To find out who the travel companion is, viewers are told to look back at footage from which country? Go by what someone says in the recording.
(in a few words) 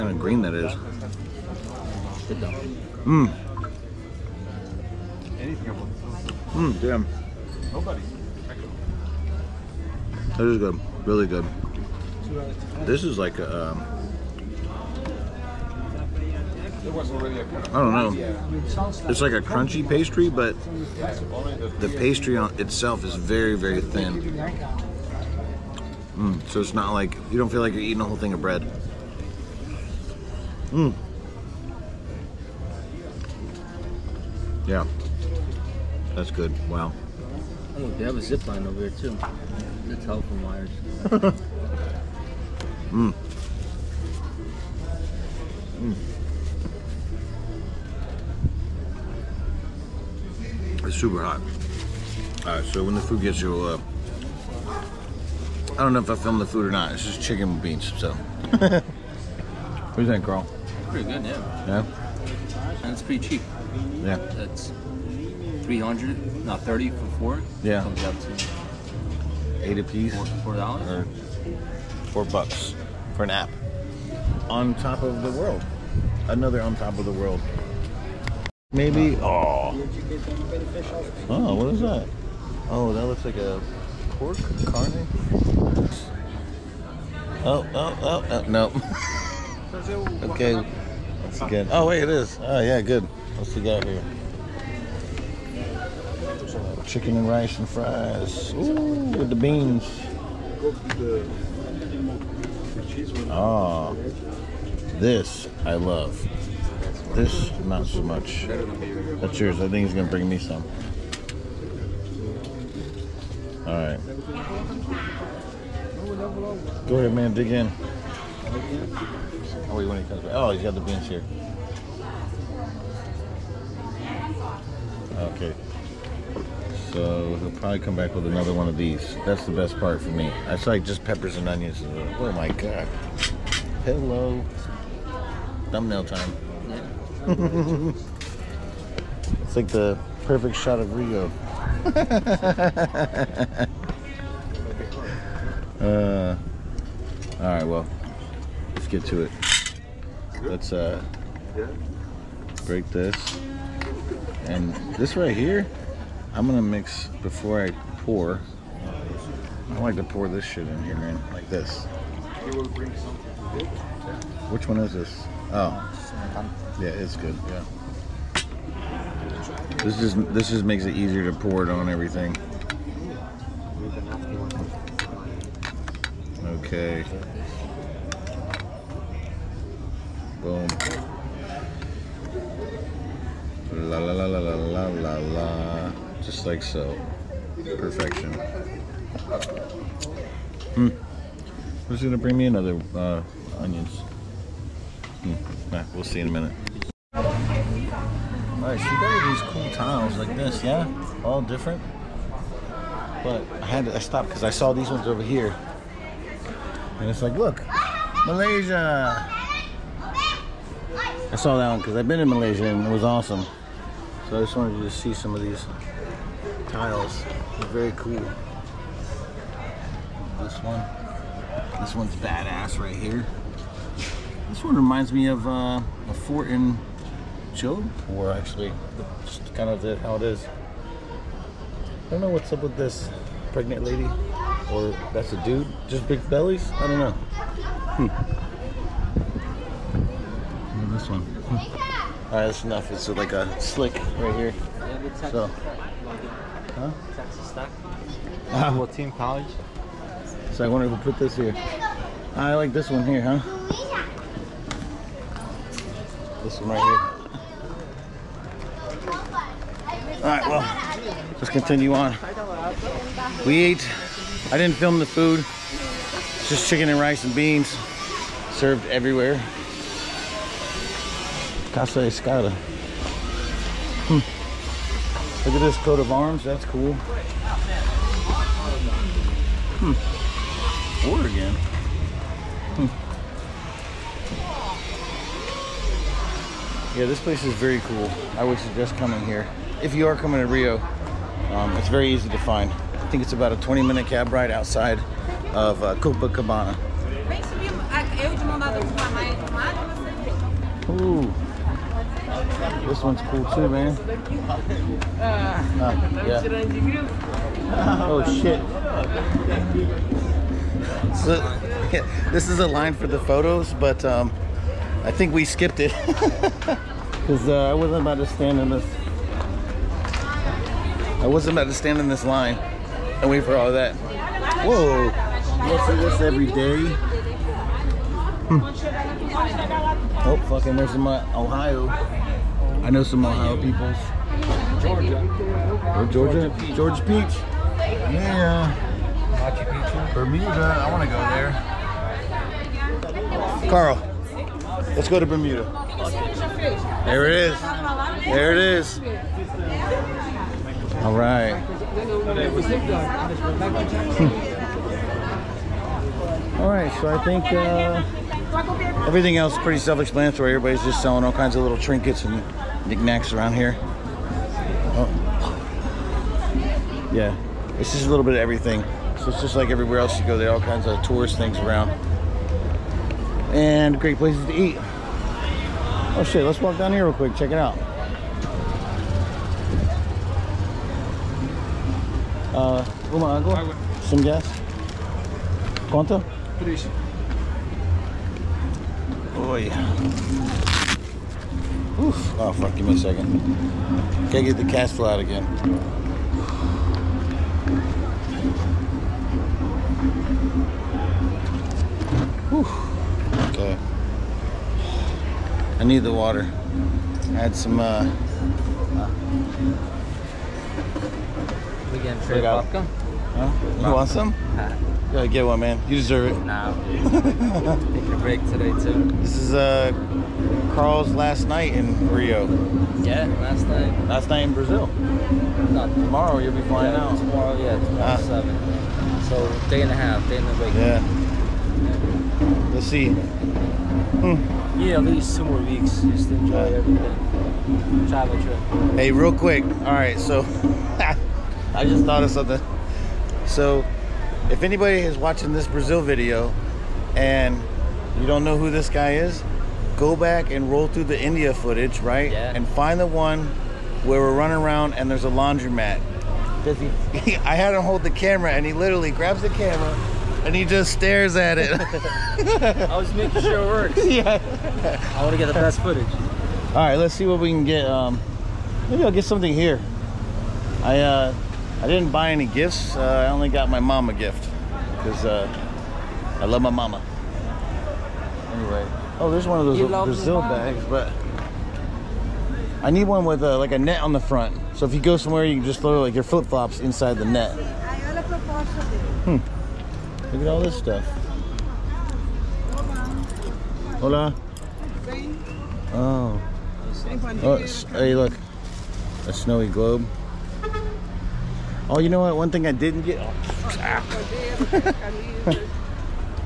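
India.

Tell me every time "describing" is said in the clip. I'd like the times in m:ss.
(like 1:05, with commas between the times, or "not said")
not said.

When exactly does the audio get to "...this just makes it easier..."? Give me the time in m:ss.
2:50.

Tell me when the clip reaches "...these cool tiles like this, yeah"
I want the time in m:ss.
3:19.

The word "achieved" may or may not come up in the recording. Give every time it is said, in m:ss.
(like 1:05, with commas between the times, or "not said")
not said.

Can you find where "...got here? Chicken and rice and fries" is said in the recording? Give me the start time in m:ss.
1:33.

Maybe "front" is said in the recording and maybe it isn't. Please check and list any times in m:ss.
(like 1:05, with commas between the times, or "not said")
8:04.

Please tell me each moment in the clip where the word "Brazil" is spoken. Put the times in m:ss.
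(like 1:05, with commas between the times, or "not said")
7:04, 7:25, 8:00.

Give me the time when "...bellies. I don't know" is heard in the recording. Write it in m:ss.
3:56.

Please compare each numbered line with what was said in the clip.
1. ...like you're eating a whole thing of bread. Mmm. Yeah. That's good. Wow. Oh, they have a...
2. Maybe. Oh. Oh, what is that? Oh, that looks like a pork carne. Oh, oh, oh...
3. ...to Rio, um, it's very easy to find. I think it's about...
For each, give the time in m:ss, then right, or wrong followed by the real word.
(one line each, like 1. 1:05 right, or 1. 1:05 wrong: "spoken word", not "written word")
1. 0:27 right
2. 1:18 right
3. 4:50 right.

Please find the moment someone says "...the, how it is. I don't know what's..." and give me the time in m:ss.
3:49.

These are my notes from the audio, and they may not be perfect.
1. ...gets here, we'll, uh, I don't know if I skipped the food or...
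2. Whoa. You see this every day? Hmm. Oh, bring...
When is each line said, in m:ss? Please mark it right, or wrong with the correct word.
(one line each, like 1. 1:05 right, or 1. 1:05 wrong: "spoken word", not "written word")
1. 0:53 wrong: "filmed", not "skipped"
2. 5:24 wrong: "fucking", not "bring".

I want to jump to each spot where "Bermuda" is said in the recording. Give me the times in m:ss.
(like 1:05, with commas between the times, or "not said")
5:40, 5:45.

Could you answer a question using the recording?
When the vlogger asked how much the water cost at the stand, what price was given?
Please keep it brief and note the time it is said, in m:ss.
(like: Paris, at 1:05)
Três, at 6:26.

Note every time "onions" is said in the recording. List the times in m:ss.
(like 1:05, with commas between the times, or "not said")
2:11, 3:13.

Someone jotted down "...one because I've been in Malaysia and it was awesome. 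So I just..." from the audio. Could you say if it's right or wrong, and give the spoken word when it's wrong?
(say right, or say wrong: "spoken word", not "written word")
right.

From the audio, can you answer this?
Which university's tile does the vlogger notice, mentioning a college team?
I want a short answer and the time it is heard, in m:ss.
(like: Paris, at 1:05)
Texas Tech, at 4:07.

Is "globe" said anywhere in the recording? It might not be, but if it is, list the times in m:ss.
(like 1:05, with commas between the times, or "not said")
8:19.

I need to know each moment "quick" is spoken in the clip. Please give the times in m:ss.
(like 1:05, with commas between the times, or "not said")
6:17, 7:19.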